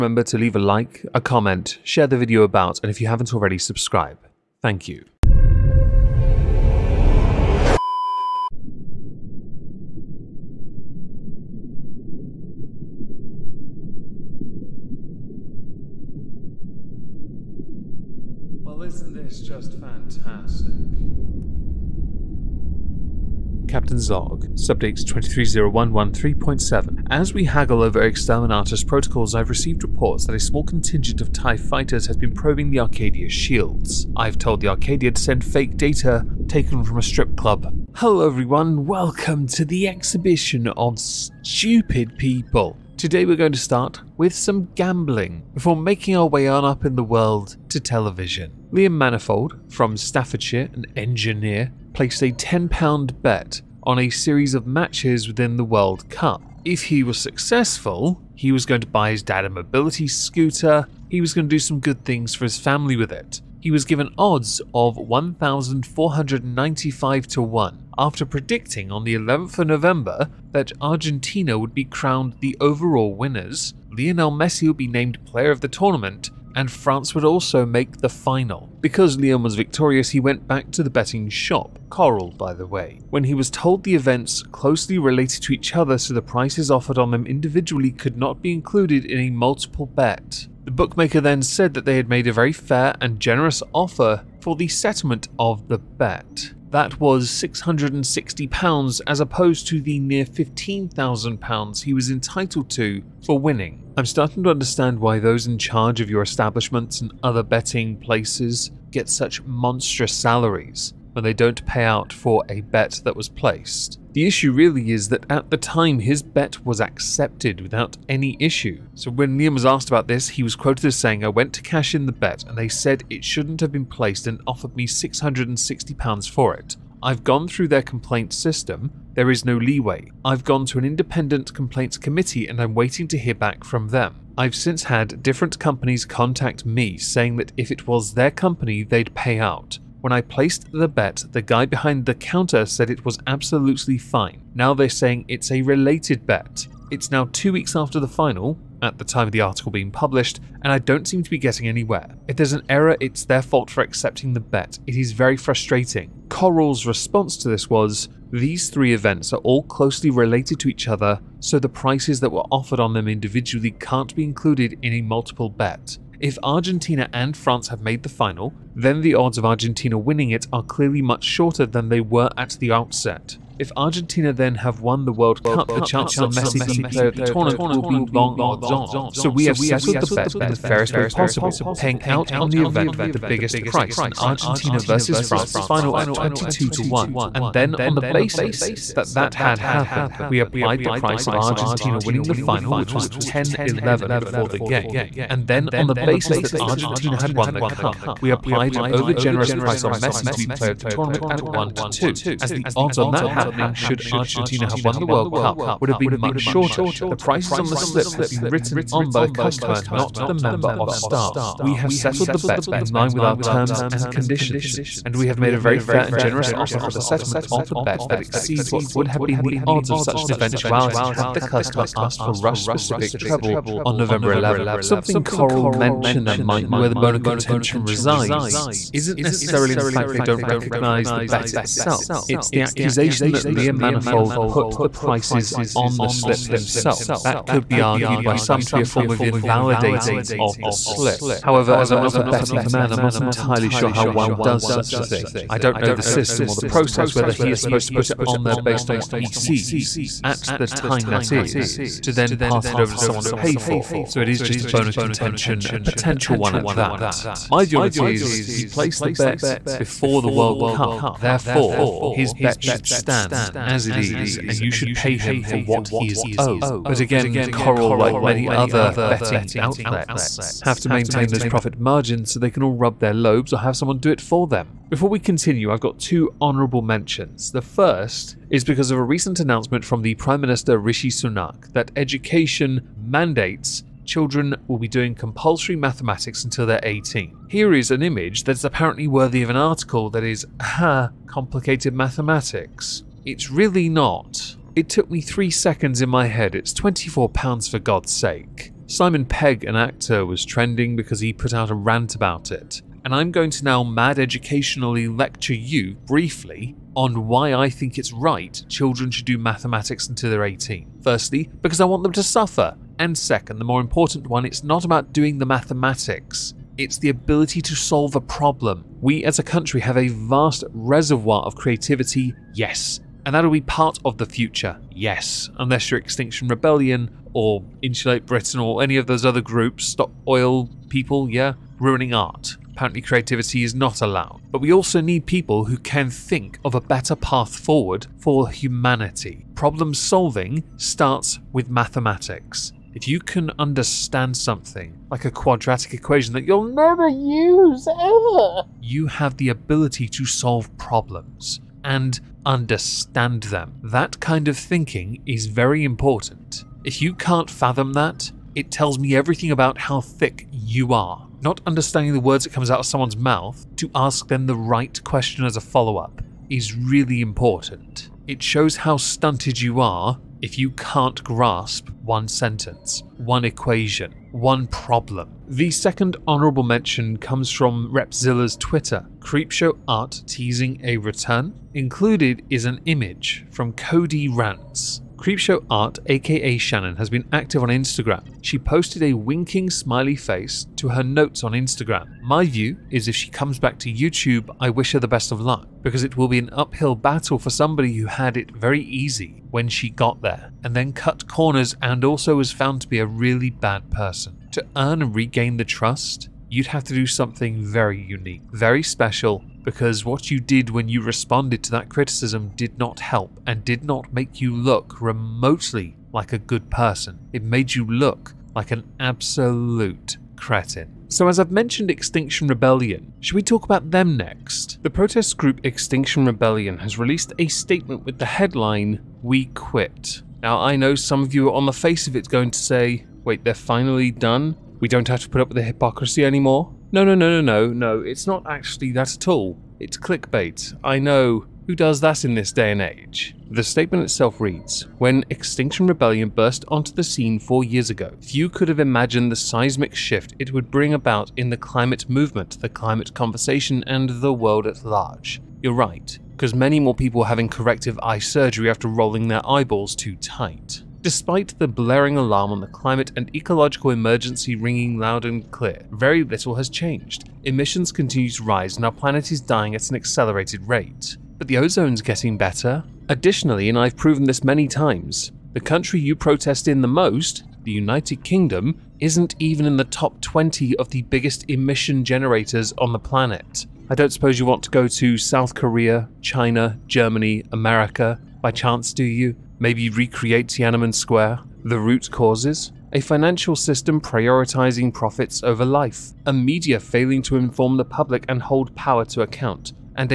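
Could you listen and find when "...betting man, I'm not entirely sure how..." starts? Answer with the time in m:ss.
4:02.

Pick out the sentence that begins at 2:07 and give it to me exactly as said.
I've gone through their complaint system, there is no leeway.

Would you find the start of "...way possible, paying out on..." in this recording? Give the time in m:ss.
3:00.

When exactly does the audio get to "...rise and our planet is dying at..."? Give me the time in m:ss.
7:48.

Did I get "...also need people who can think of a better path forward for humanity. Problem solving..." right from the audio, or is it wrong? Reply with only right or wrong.
right.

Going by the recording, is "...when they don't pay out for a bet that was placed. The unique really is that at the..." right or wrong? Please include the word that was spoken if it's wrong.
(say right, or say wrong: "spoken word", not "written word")
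wrong: "issue", not "unique".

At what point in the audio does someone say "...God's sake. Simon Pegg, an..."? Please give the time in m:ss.
4:57.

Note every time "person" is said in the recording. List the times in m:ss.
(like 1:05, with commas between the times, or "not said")
6:43, 6:56.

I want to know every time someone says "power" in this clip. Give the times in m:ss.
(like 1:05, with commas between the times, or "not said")
8:18.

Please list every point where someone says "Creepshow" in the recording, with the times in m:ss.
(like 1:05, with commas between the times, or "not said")
6:19, 6:25.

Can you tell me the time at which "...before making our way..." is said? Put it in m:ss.
0:45.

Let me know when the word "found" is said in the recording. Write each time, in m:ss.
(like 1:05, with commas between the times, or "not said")
6:42.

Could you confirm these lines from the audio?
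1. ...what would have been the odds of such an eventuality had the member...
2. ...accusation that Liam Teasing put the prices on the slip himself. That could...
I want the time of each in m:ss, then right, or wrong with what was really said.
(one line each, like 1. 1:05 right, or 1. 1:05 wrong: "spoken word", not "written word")
1. 3:38 wrong: "customer", not "member"
2. 3:52 wrong: "Manifold", not "Teasing".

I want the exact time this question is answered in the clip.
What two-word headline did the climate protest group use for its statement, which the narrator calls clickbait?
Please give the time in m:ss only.
7:09.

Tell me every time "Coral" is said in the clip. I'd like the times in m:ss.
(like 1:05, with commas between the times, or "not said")
1:21, 2:36, 3:45, 4:27.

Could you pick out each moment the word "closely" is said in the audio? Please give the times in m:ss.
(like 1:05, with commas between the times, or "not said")
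1:24, 2:39.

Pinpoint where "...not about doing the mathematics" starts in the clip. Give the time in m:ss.
5:14.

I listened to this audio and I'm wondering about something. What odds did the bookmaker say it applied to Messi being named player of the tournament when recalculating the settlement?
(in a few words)
1 to 2.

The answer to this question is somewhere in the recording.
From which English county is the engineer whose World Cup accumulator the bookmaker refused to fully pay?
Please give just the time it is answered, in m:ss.
0:49.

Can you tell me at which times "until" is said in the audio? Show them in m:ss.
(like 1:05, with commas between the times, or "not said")
4:46, 5:10.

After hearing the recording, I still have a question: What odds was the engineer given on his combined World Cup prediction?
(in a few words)
1,495 to 1.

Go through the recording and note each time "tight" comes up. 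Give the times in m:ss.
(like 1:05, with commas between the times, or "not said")
7:40.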